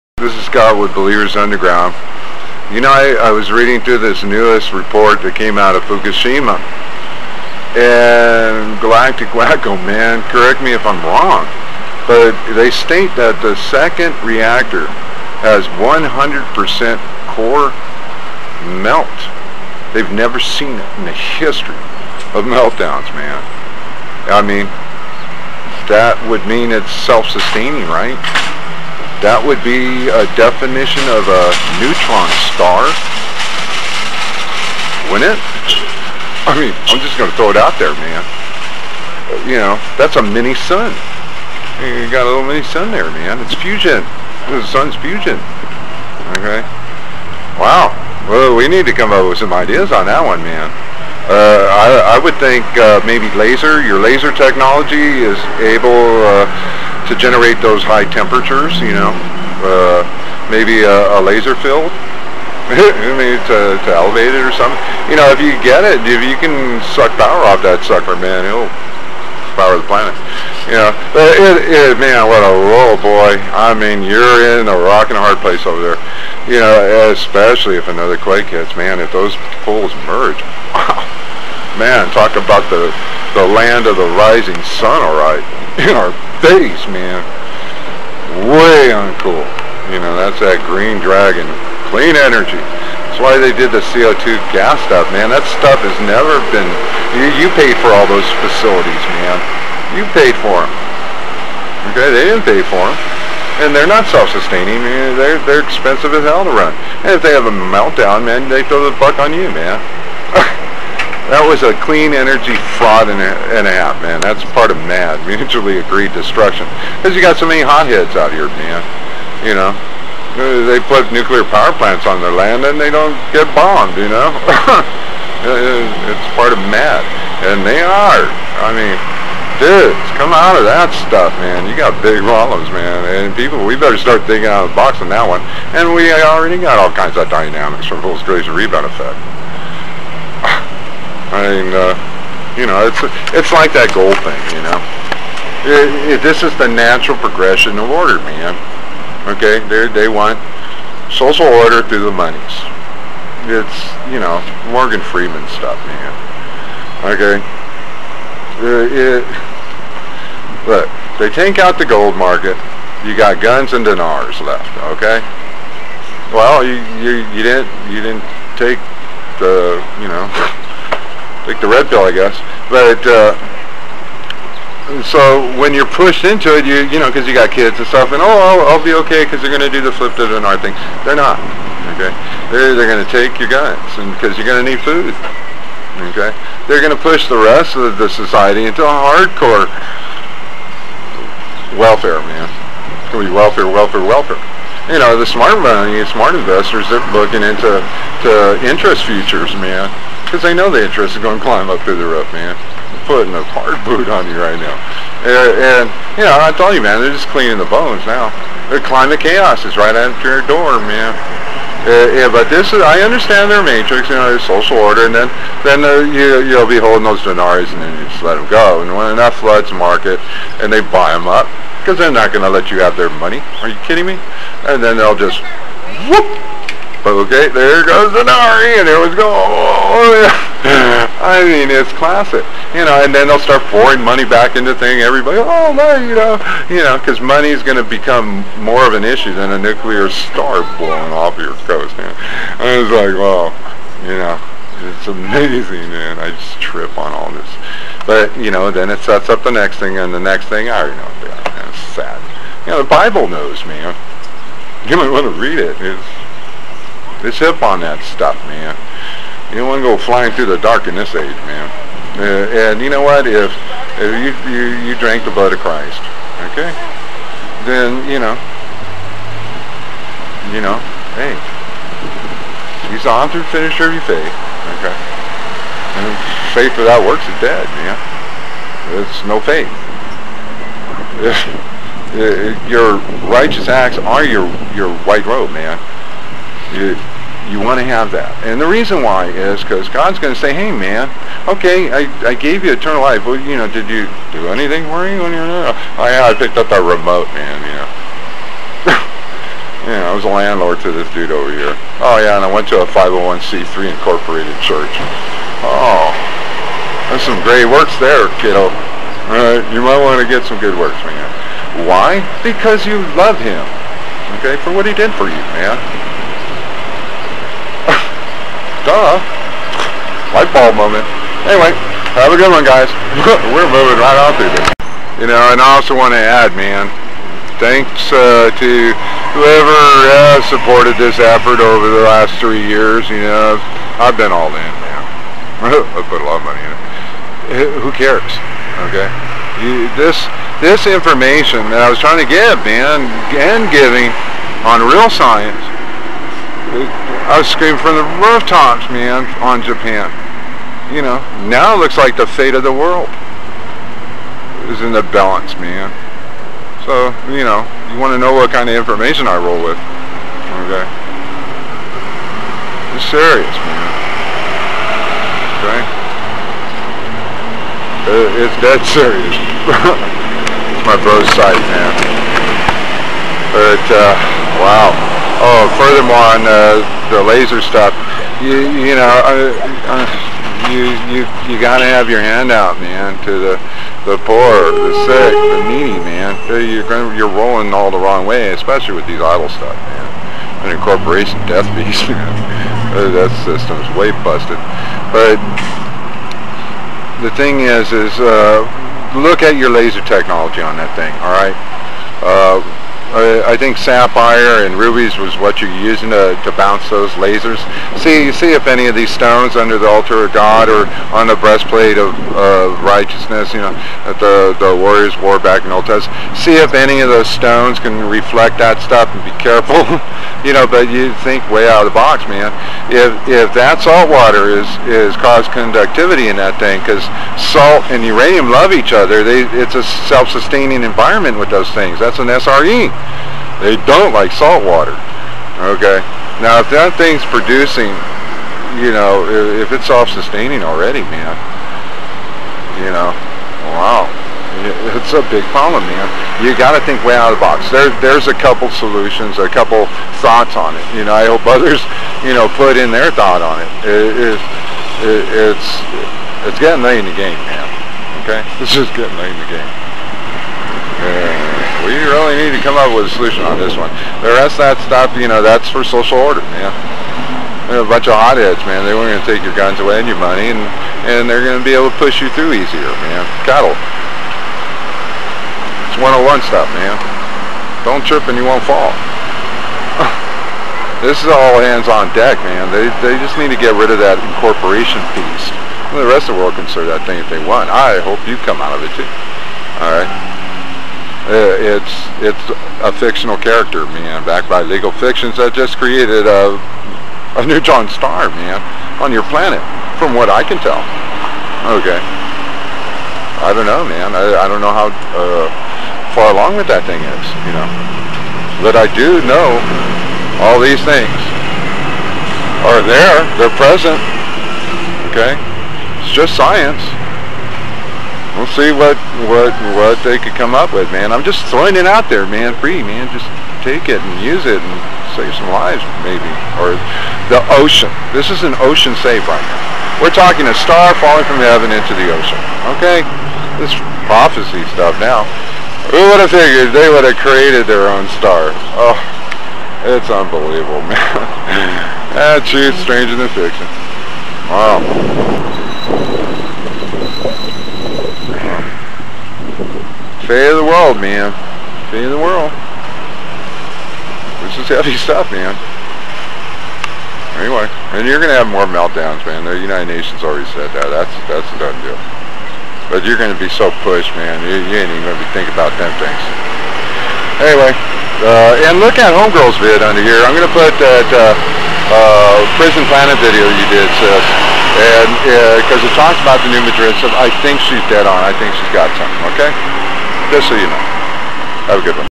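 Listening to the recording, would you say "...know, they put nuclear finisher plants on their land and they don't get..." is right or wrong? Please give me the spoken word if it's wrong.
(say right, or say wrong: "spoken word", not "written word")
wrong: "power", not "finisher".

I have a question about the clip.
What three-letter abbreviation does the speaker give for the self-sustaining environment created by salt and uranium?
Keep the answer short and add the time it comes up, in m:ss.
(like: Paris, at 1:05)
SRE, at 7:12.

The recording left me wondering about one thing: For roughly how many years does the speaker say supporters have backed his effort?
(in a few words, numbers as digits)
3.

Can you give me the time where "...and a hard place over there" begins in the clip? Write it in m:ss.
1:15.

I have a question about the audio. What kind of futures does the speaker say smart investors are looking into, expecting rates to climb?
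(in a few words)
Interest futures.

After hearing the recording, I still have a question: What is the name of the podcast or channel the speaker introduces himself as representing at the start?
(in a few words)
Believers Underground.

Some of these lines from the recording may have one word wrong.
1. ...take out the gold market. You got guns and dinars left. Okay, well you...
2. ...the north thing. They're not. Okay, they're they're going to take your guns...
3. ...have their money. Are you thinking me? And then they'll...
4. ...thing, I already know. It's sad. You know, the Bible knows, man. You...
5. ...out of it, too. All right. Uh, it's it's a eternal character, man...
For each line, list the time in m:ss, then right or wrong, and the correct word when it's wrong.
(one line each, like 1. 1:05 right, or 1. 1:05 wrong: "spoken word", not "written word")
1. 2:41 right
2. 3:00 right
3. 3:42 wrong: "kidding", not "thinking"
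4. 4:10 right
5. 8:08 wrong: "fictional", not "eternal".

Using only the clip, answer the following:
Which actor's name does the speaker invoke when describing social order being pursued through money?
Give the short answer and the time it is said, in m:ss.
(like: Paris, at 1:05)
Morgan Freeman, at 2:34.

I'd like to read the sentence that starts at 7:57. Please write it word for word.
Don't trip and you won't fall.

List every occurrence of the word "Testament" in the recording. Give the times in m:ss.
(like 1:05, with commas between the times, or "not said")
6:55.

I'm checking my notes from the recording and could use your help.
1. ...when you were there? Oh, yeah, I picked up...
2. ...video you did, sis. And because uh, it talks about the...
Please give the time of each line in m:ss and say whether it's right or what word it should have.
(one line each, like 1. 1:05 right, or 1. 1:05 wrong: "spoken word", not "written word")
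1. 4:55 right
2. 9:33 right.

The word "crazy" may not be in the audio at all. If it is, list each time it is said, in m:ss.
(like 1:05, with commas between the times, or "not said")
2:18.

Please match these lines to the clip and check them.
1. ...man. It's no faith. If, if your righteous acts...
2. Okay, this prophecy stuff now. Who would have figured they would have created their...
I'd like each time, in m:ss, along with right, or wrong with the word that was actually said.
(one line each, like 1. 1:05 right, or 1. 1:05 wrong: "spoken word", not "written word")
1. 4:37 right
2. 8:52 right.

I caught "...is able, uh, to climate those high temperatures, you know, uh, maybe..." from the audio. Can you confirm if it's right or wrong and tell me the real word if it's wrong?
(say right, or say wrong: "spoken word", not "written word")
wrong: "generate", not "climate".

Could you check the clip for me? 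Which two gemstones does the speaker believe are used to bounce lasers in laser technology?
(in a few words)
Sapphire and rubies.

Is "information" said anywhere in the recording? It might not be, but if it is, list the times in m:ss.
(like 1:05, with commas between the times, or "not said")
5:40, 5:58.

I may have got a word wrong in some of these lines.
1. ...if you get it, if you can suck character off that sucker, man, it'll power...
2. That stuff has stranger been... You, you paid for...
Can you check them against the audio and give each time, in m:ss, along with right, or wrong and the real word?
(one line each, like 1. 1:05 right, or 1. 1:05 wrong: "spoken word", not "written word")
1. 1:05 wrong: "power", not "character"
2. 1:35 wrong: "never", not "stranger".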